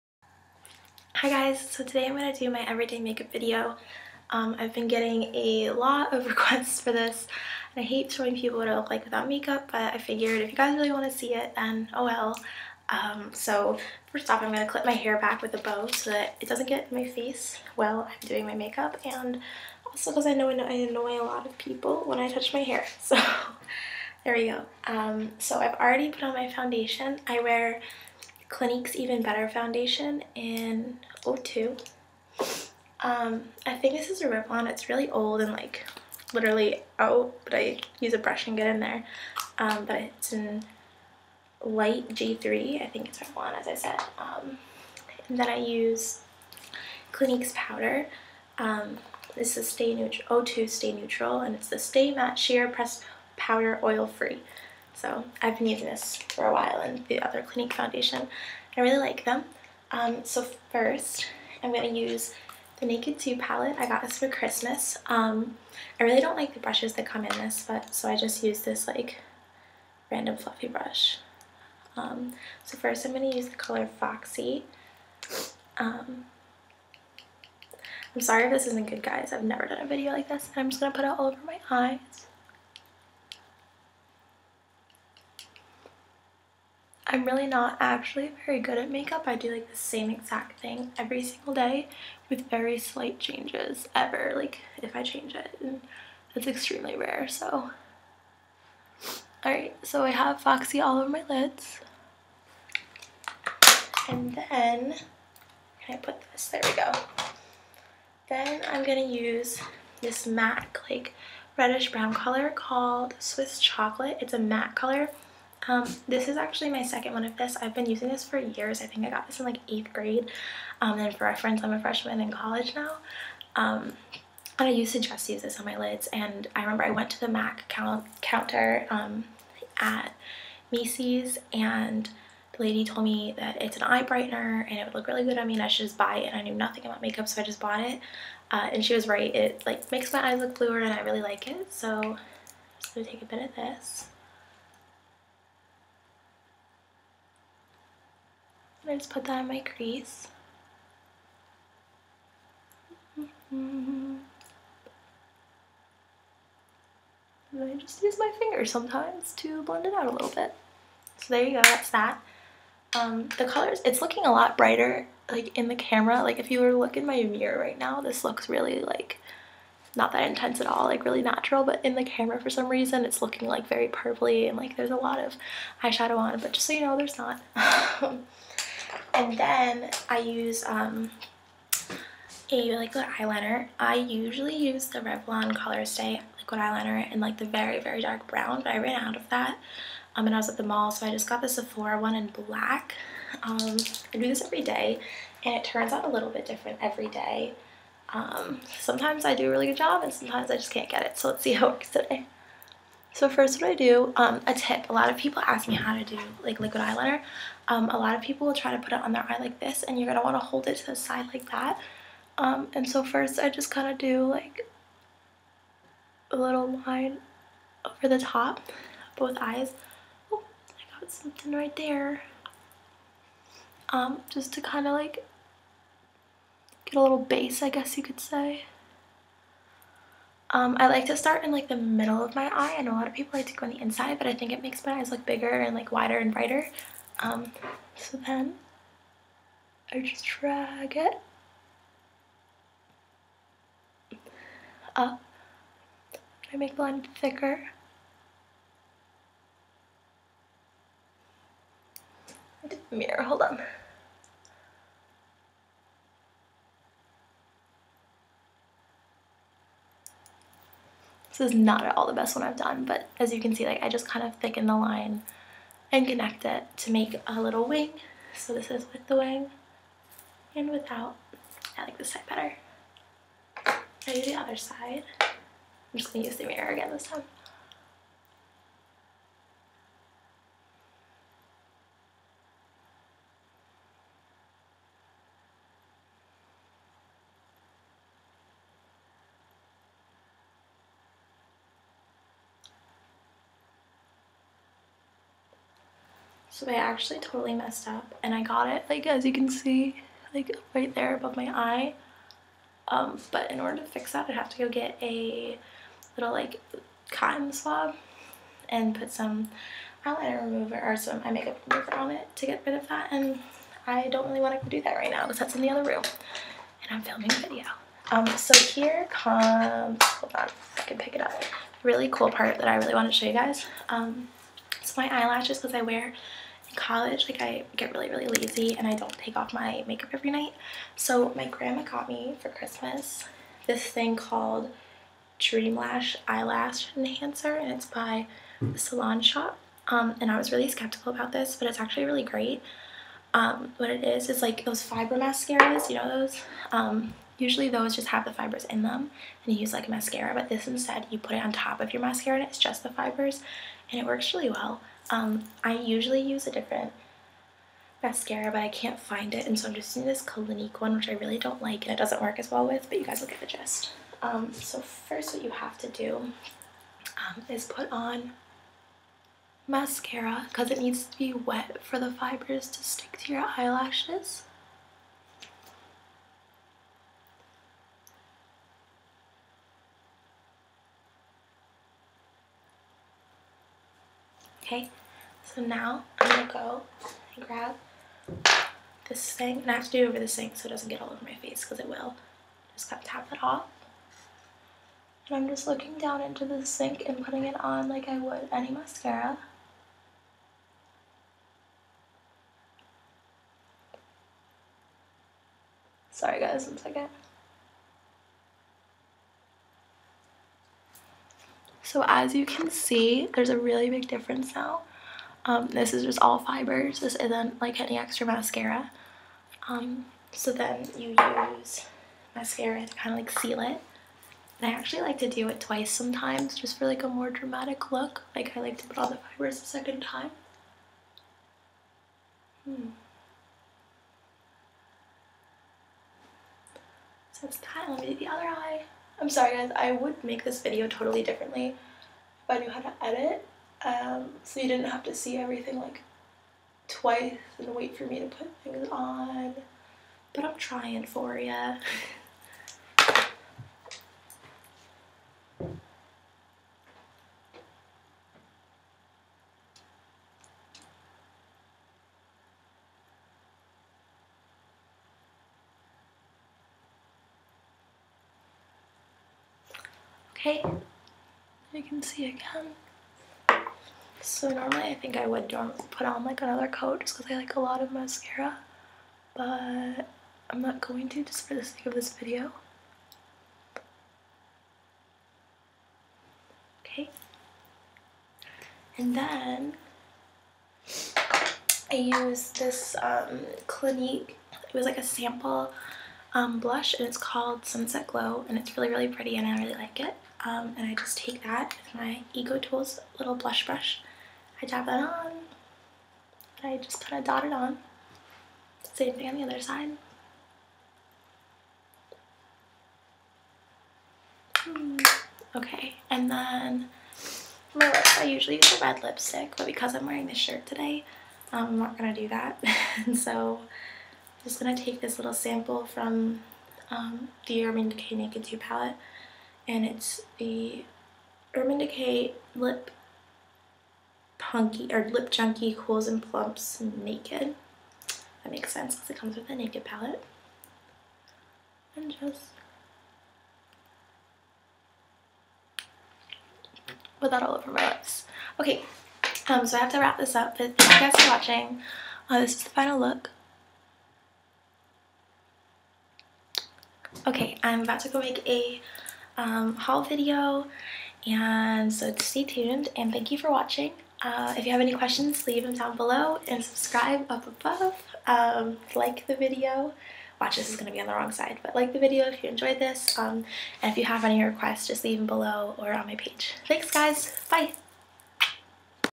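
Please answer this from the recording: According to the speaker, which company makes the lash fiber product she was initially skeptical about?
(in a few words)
the Salon Shop.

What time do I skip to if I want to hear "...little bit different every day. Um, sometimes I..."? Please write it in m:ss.
3:16.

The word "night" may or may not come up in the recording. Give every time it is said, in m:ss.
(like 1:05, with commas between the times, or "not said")
5:30.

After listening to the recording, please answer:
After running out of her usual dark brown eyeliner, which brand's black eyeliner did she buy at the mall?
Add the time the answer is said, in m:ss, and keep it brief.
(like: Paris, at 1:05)
Sephora, at 3:11.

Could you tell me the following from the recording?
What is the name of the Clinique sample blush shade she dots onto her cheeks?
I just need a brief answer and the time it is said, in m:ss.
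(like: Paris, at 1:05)
Sunset Glow, at 8:17.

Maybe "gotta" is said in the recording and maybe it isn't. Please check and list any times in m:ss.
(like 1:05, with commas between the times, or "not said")
6:32.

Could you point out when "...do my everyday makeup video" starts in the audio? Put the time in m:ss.
0:02.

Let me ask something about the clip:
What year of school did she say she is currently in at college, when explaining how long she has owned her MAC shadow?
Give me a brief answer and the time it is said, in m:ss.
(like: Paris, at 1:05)
freshman, at 2:01.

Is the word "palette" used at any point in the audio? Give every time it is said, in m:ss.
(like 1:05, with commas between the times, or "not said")
1:03, 8:48, 8:59.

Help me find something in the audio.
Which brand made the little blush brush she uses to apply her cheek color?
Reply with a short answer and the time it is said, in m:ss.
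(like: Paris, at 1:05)
EcoTools, at 8:22.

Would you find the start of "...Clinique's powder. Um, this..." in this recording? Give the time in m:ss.
0:47.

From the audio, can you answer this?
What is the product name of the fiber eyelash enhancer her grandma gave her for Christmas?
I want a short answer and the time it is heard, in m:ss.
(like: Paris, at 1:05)
Dream Lash, at 5:35.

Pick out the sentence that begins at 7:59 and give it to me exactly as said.
But I'm not going to just for the sake of this video.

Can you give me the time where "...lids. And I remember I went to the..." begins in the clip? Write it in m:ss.
2:05.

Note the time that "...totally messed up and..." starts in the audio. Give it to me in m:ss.
4:57.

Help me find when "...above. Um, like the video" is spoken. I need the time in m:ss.
9:27.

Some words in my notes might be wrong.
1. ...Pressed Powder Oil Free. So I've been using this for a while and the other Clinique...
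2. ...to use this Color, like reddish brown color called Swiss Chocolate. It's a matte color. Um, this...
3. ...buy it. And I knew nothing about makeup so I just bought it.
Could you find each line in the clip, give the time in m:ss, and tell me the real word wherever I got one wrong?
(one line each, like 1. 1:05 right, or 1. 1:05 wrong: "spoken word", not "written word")
1. 0:52 right
2. 1:49 wrong: "MAC", not "Color"
3. 2:15 right.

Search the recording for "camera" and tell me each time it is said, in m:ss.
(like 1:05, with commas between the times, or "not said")
2:45, 2:52.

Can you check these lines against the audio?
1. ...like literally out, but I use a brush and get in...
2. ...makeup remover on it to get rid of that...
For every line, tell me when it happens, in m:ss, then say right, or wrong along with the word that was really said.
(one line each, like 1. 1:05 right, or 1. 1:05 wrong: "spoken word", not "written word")
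1. 0:35 right
2. 5:11 right.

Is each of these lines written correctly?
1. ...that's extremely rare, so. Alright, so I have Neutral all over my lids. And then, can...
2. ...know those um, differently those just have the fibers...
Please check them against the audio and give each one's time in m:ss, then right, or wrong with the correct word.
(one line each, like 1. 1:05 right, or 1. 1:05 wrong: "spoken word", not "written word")
1. 1:36 wrong: "Foxy", not "Neutral"
2. 5:45 wrong: "usually", not "differently".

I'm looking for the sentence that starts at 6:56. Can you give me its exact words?
This isn't like any extra mascara.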